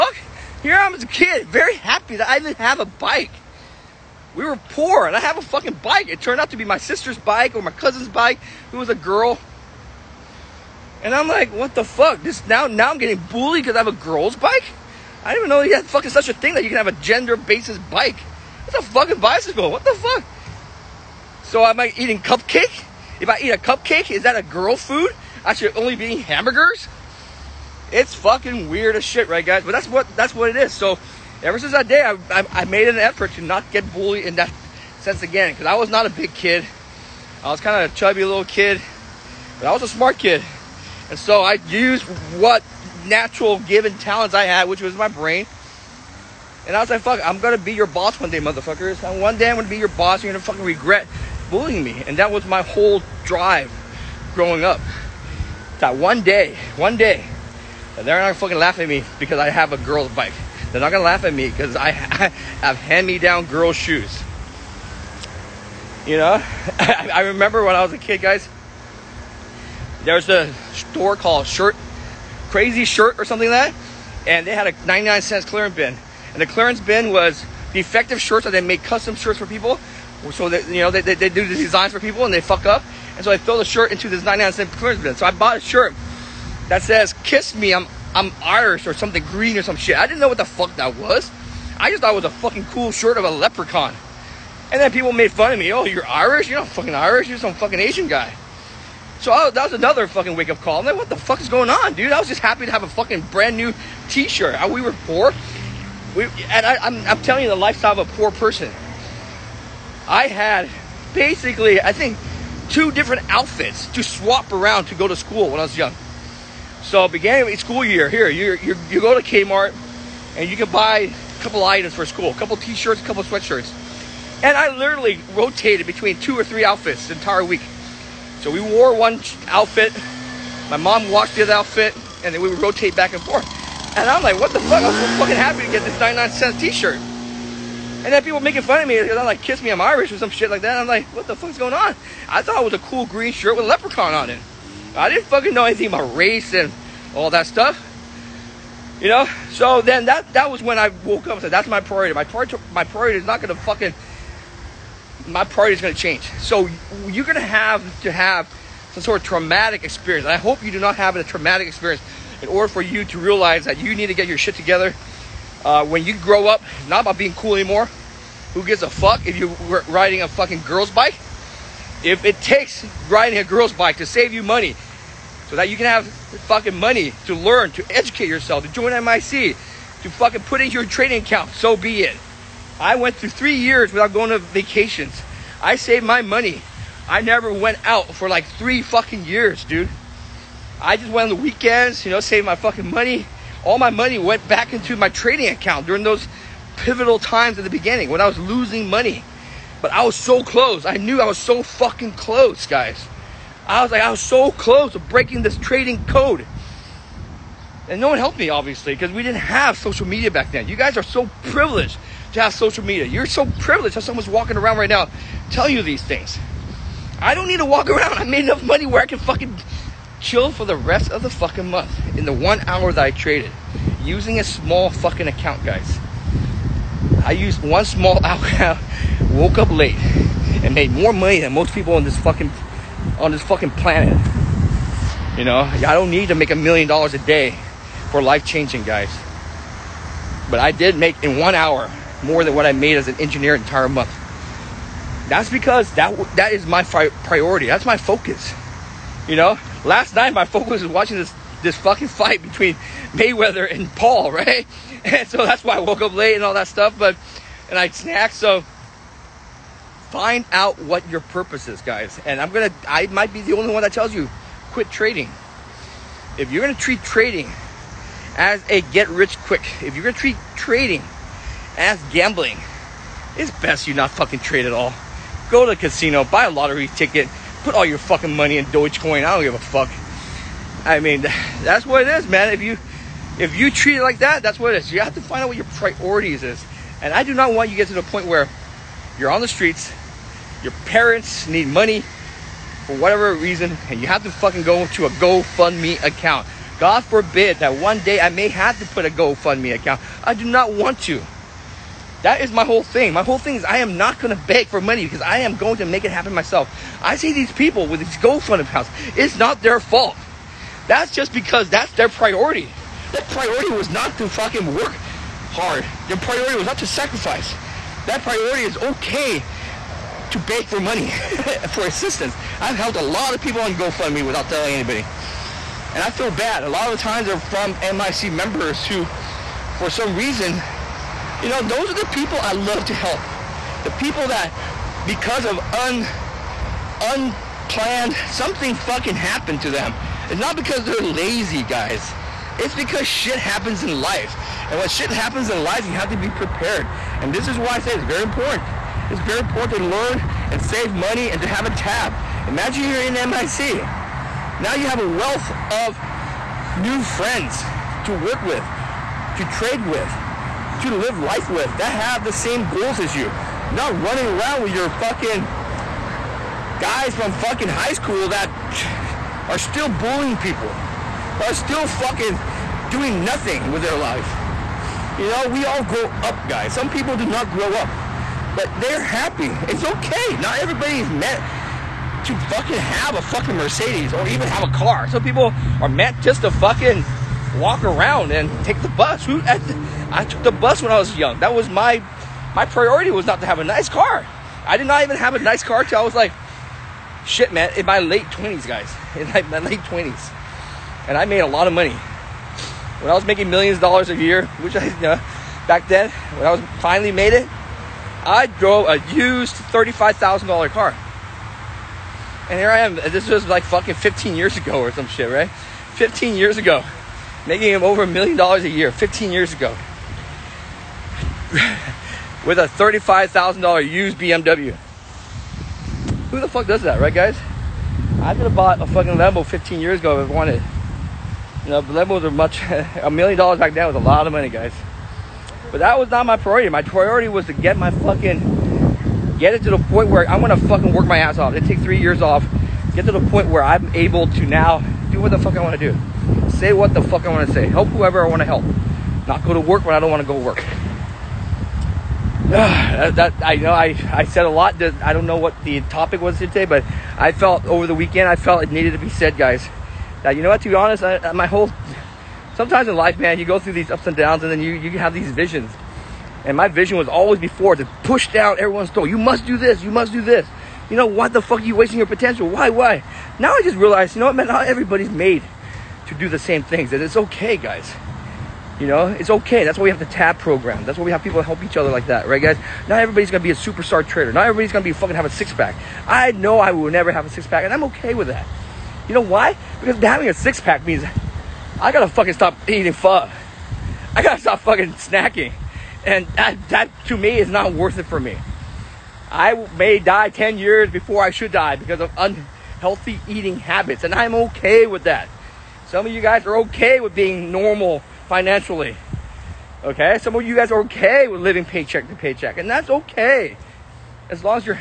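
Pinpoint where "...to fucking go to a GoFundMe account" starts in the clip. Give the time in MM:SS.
04:54.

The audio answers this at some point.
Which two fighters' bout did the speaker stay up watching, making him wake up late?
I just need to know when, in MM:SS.
04:13.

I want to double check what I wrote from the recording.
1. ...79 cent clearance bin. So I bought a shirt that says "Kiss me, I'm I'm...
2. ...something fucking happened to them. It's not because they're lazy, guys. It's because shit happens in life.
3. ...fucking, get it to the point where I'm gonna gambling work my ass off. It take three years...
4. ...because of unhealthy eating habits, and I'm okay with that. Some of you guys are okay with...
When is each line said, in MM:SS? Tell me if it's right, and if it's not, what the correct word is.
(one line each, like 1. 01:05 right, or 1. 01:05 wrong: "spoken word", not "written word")
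1. 01:24 wrong: "99", not "79"
2. 05:38 right
3. 07:17 wrong: "fucking", not "gambling"
4. 08:21 right.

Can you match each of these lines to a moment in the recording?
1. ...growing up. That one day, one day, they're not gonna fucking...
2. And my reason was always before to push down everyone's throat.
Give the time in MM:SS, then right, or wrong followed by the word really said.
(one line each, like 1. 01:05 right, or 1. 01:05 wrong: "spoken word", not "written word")
1. 00:54 right
2. 07:46 wrong: "vision", not "reason".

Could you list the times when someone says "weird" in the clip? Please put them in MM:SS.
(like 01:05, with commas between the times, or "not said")
00:28.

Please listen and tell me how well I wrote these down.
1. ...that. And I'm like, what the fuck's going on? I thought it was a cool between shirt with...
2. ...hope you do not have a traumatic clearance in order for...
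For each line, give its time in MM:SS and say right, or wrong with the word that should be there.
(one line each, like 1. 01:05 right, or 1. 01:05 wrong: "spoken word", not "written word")
1. 02:20 wrong: "green", not "between"
2. 02:40 wrong: "experience", not "clearance".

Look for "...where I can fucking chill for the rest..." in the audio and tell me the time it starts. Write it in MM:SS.
03:38.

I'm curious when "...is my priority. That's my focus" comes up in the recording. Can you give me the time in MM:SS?
04:06.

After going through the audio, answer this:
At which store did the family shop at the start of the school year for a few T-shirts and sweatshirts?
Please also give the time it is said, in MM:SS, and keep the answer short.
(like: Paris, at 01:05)
Kmart, at 01:59.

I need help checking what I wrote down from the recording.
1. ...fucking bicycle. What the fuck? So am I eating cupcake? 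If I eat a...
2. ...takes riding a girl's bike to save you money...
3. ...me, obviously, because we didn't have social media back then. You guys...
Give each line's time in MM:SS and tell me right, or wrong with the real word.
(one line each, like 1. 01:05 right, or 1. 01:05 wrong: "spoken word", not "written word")
1. 00:18 right
2. 02:52 right
3. 03:28 right.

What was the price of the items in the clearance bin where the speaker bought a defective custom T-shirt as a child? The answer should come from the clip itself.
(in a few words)
99 cents.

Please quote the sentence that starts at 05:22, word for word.
I've helped a lot of people on GoFundMe without telling anybody.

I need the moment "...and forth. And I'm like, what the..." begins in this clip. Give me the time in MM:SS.
02:13.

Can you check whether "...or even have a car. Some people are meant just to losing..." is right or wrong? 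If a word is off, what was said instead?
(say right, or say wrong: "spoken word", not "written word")
wrong: "fucking", not "losing".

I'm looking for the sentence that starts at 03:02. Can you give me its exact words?
I went through three years without going to vacations.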